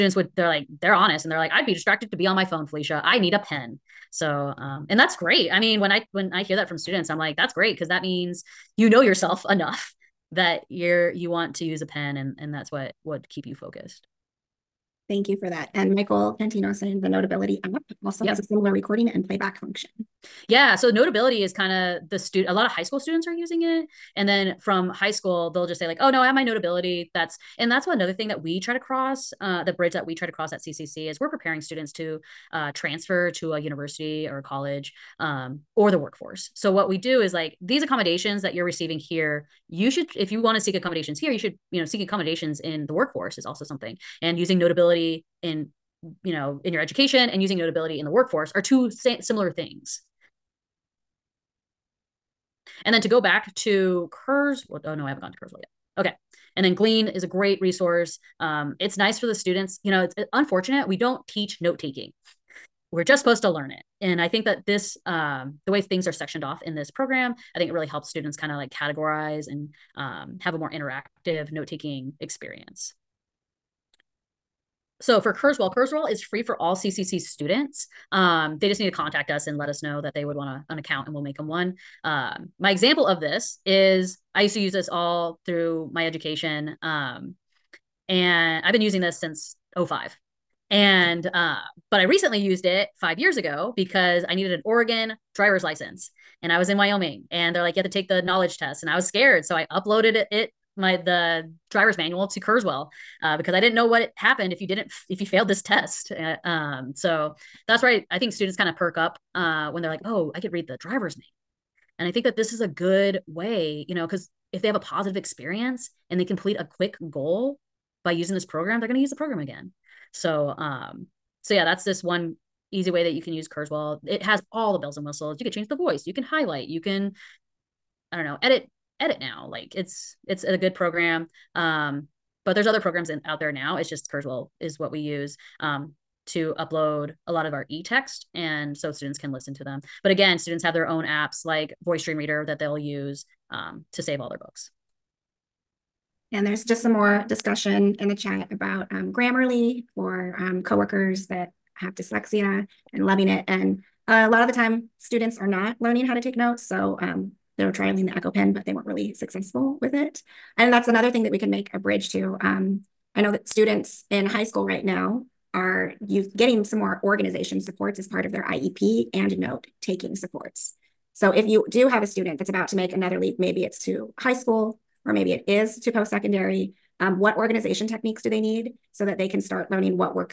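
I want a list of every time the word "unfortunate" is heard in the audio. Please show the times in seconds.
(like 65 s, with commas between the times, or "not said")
60 s.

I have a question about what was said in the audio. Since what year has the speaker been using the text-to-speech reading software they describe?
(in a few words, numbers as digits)
2005.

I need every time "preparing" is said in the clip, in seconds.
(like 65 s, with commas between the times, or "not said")
31 s.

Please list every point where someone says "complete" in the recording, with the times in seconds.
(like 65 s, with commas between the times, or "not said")
116 s.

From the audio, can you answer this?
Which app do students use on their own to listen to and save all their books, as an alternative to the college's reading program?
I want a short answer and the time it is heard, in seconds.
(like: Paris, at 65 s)
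Voice Dream Reader, at 141 s.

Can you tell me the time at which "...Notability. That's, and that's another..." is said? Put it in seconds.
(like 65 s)
26 s.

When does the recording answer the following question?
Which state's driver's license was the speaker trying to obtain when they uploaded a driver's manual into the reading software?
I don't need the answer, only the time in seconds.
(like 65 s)
94 s.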